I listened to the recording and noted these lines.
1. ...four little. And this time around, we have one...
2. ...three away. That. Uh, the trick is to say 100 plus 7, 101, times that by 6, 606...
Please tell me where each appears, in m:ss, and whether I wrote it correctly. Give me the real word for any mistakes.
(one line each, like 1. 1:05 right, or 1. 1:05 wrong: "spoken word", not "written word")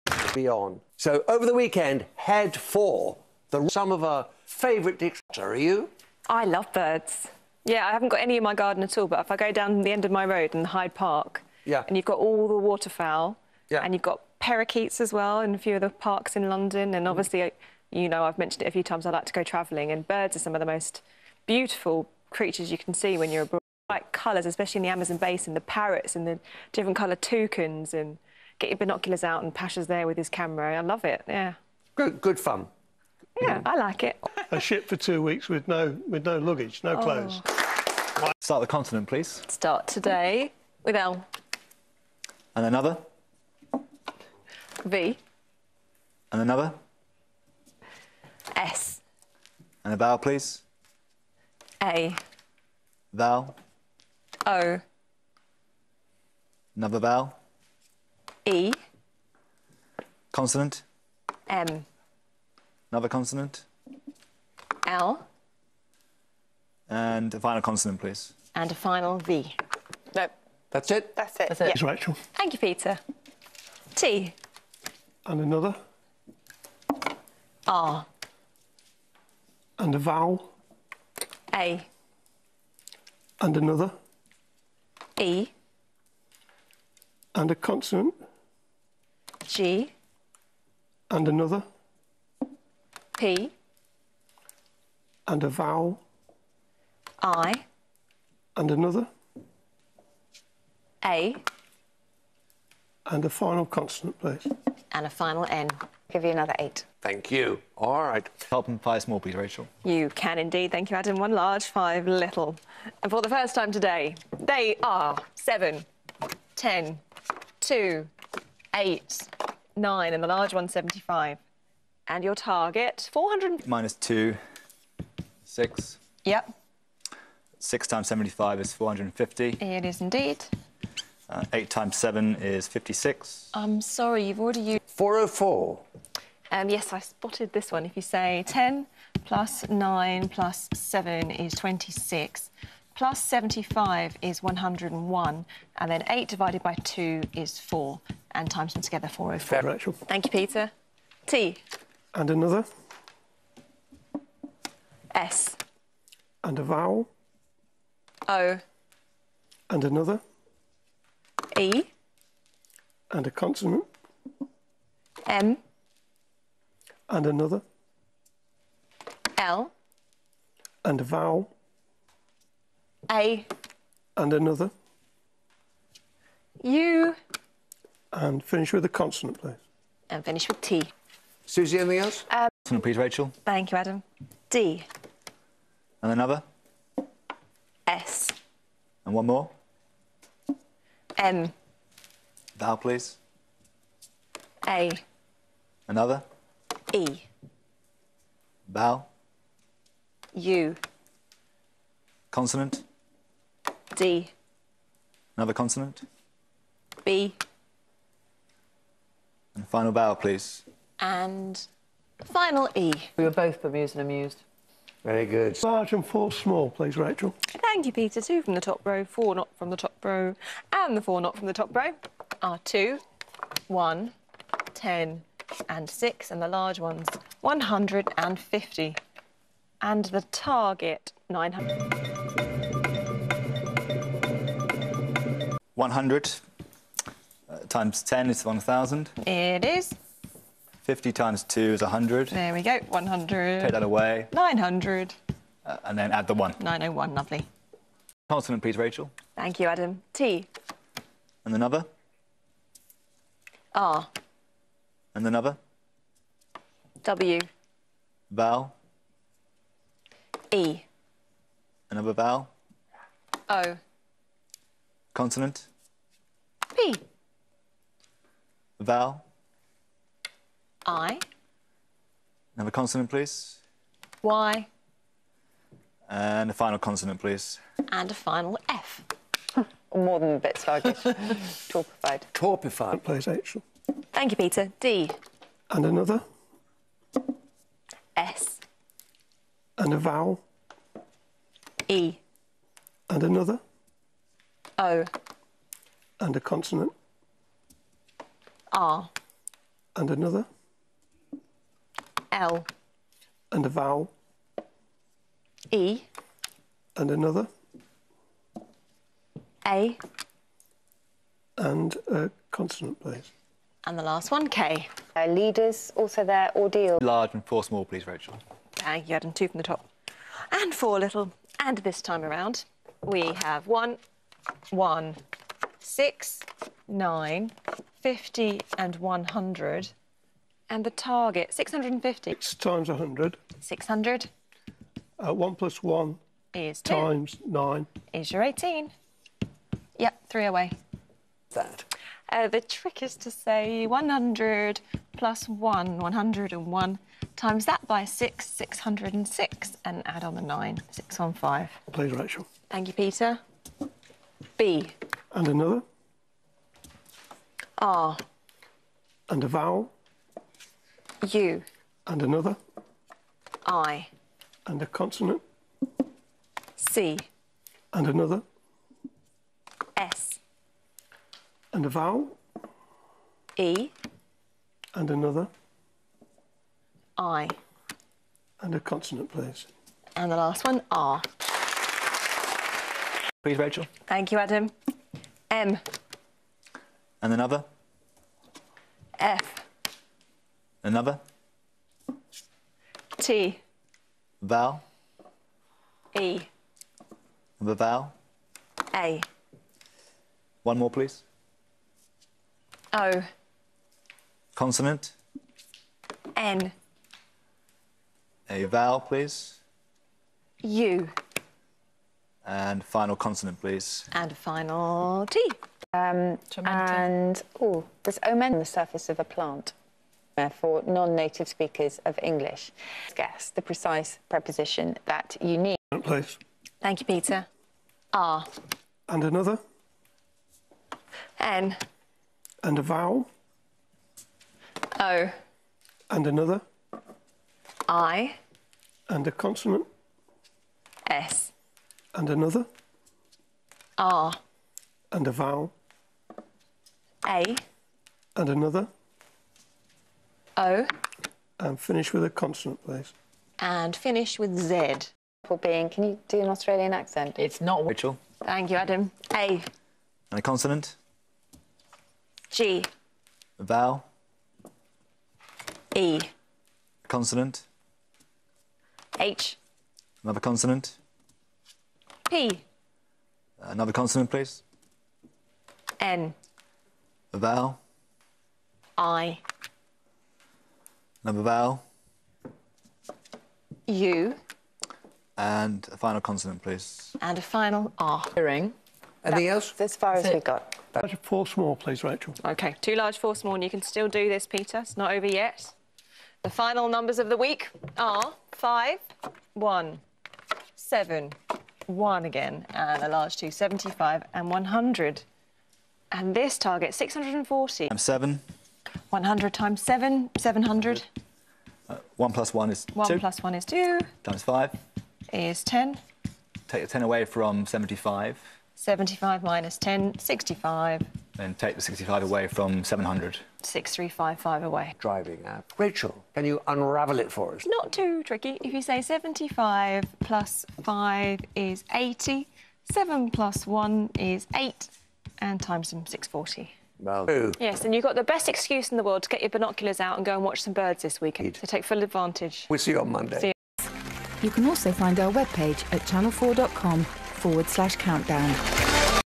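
1. 5:20 right
2. 5:40 wrong: "1", not "7".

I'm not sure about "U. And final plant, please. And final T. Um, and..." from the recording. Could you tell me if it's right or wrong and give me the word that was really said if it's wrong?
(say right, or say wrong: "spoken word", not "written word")
wrong: "consonant", not "plant".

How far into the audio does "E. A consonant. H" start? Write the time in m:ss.
7:45.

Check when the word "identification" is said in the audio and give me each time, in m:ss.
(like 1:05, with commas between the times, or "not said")
not said.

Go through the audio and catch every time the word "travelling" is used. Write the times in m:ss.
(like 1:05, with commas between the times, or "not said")
0:19.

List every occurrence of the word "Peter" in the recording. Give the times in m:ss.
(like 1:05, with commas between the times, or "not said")
1:12, 2:30, 3:37, 4:44, 5:52, 7:07, 8:14.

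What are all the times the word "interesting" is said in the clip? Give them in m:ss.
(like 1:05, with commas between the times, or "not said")
not said.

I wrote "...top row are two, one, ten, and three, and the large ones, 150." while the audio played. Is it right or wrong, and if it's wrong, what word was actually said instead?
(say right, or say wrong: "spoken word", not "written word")
wrong: "six", not "three".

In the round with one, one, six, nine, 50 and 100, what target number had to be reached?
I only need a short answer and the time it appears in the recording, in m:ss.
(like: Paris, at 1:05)
650, at 5:31.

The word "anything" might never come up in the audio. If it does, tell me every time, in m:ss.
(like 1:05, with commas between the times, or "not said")
3:01, 8:09.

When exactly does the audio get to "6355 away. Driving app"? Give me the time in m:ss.
8:43.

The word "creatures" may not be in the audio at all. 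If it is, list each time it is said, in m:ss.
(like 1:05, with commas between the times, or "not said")
0:22.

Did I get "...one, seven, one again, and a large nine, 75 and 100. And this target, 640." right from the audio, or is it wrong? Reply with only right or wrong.
wrong.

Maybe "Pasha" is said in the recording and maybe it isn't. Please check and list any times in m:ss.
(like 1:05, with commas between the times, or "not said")
0:29.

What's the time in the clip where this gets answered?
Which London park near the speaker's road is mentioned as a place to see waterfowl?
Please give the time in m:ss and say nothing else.
0:10.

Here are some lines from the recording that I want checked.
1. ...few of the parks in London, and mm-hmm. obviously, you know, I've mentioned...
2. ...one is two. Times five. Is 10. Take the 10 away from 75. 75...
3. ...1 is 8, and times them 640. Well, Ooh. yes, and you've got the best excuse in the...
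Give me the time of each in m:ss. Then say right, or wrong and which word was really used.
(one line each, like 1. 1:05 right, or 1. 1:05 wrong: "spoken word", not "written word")
1. 0:15 right
2. 8:33 right
3. 8:53 right.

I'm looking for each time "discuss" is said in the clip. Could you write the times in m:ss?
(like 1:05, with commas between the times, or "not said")
not said.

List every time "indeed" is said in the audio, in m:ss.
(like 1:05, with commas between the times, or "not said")
1:50, 2:10.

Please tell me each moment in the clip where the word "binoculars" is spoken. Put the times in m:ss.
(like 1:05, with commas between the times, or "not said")
0:28, 8:59.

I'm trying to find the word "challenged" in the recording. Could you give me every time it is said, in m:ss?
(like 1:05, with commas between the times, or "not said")
not said.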